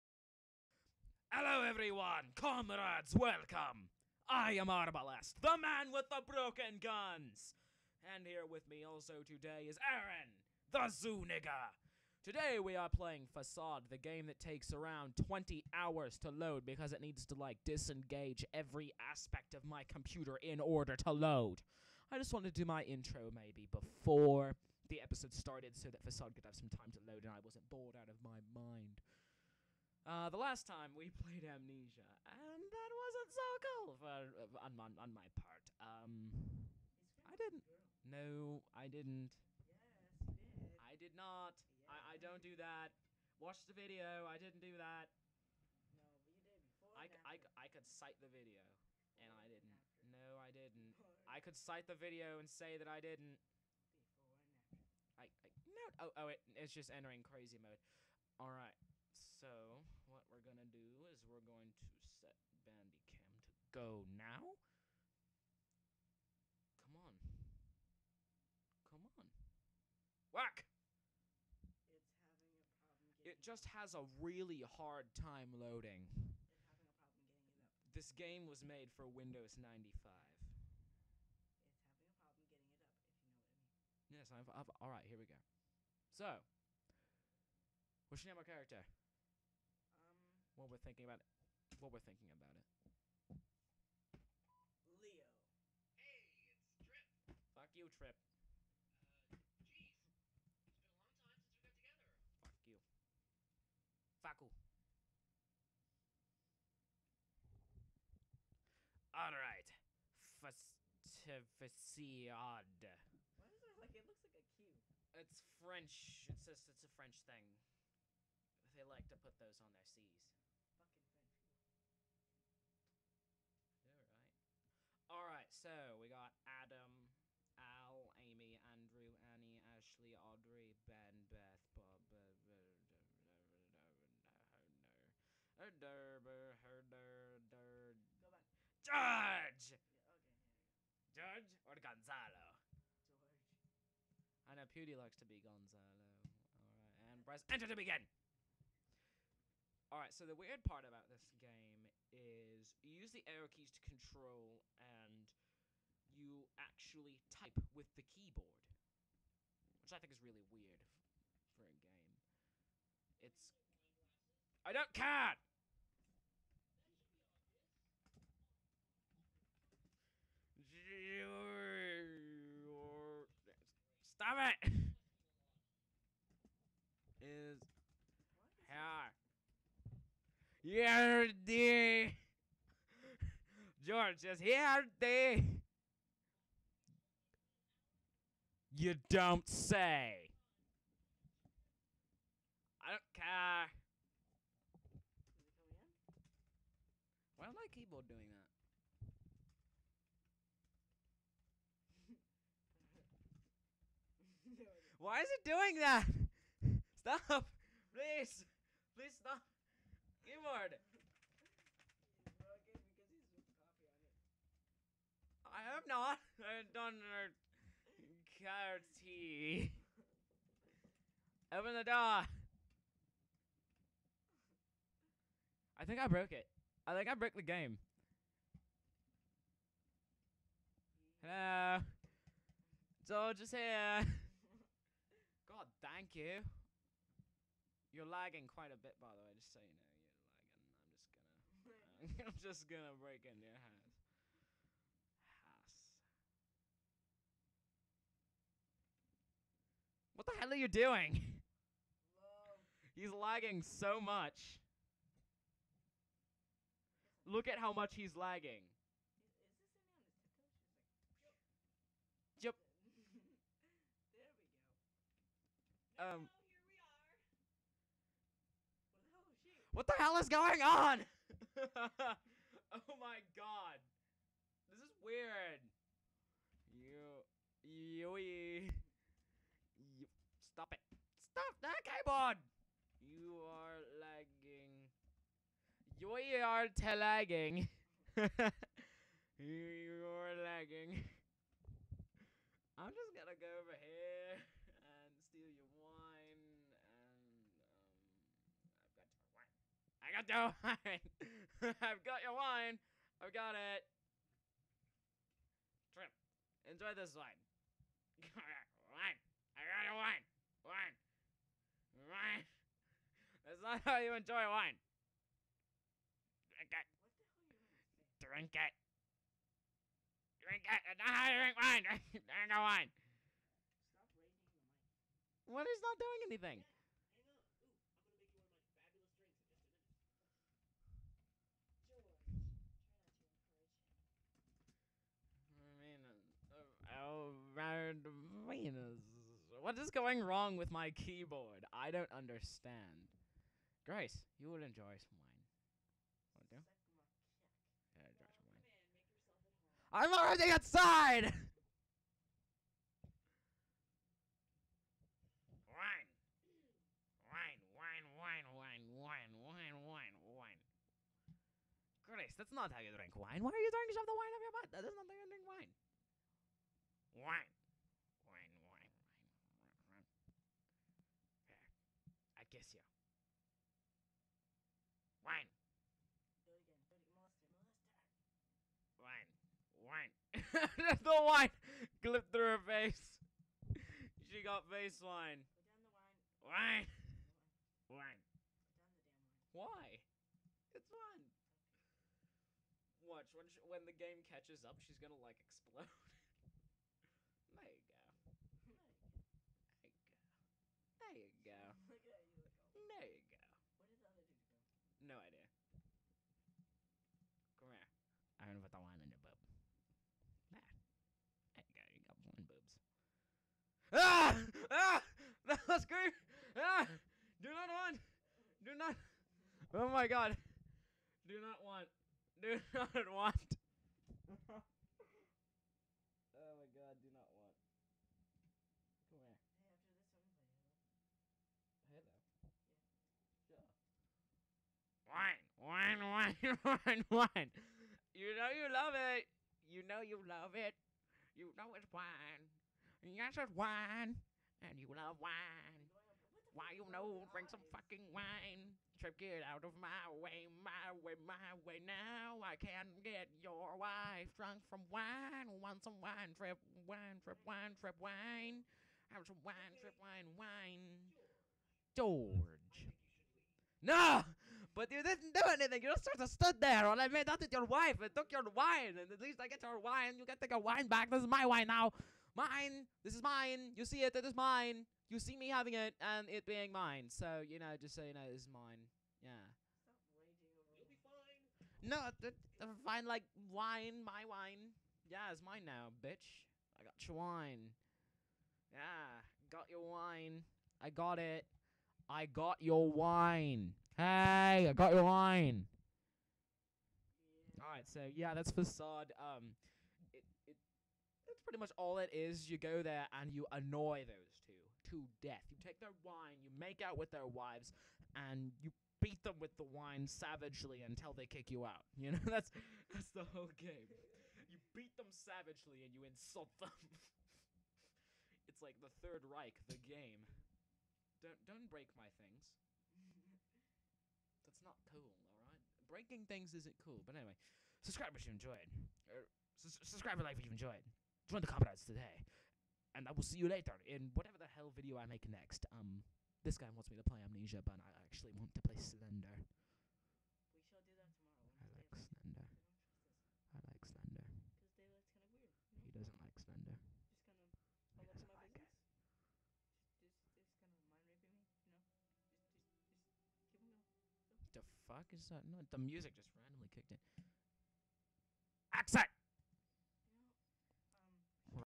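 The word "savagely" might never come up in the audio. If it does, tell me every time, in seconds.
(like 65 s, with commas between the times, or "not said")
510 s, 515 s.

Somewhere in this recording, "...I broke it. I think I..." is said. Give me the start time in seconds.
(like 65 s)
225 s.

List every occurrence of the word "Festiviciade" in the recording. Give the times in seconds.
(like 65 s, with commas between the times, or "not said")
111 s.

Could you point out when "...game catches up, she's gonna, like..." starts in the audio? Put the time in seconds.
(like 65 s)
393 s.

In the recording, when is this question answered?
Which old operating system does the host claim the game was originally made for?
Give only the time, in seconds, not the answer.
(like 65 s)
79 s.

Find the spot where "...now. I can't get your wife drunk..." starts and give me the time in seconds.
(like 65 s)
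451 s.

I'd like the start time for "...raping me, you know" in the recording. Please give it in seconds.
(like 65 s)
551 s.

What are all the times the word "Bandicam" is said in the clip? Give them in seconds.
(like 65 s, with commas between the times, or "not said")
62 s.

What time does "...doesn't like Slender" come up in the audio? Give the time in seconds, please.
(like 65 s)
545 s.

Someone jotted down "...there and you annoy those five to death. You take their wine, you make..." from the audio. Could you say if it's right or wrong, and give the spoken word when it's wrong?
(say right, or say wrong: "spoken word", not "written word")
wrong: "two", not "five".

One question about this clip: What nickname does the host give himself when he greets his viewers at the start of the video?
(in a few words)
Arbalest.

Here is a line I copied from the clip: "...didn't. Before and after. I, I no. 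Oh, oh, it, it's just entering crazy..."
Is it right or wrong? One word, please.
right.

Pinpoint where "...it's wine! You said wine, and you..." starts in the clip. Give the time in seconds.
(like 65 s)
441 s.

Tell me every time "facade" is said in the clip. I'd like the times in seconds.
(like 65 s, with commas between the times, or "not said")
13 s, 26 s, 498 s.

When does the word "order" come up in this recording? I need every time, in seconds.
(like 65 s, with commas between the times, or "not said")
20 s.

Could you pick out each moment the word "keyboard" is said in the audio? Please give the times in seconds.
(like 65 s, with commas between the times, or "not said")
158 s, 197 s, 210 s, 281 s, 340 s.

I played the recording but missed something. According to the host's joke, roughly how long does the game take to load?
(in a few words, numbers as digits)
20 hours.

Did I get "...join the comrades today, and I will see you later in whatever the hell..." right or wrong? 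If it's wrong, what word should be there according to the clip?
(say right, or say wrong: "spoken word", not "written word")
right.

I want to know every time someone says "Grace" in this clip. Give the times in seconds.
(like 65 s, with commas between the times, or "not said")
343 s, 362 s.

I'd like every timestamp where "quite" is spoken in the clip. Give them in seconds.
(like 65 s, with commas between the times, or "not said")
238 s.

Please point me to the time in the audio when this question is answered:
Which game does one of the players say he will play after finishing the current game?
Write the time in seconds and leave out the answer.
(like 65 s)
436 s.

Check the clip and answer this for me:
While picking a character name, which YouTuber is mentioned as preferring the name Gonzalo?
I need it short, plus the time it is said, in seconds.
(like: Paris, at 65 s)
Pewdie, at 144 s.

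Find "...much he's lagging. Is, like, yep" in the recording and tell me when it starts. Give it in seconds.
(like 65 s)
257 s.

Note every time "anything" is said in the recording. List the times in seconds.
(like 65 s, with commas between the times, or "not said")
326 s, 465 s.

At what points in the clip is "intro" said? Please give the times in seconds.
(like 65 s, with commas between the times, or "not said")
22 s.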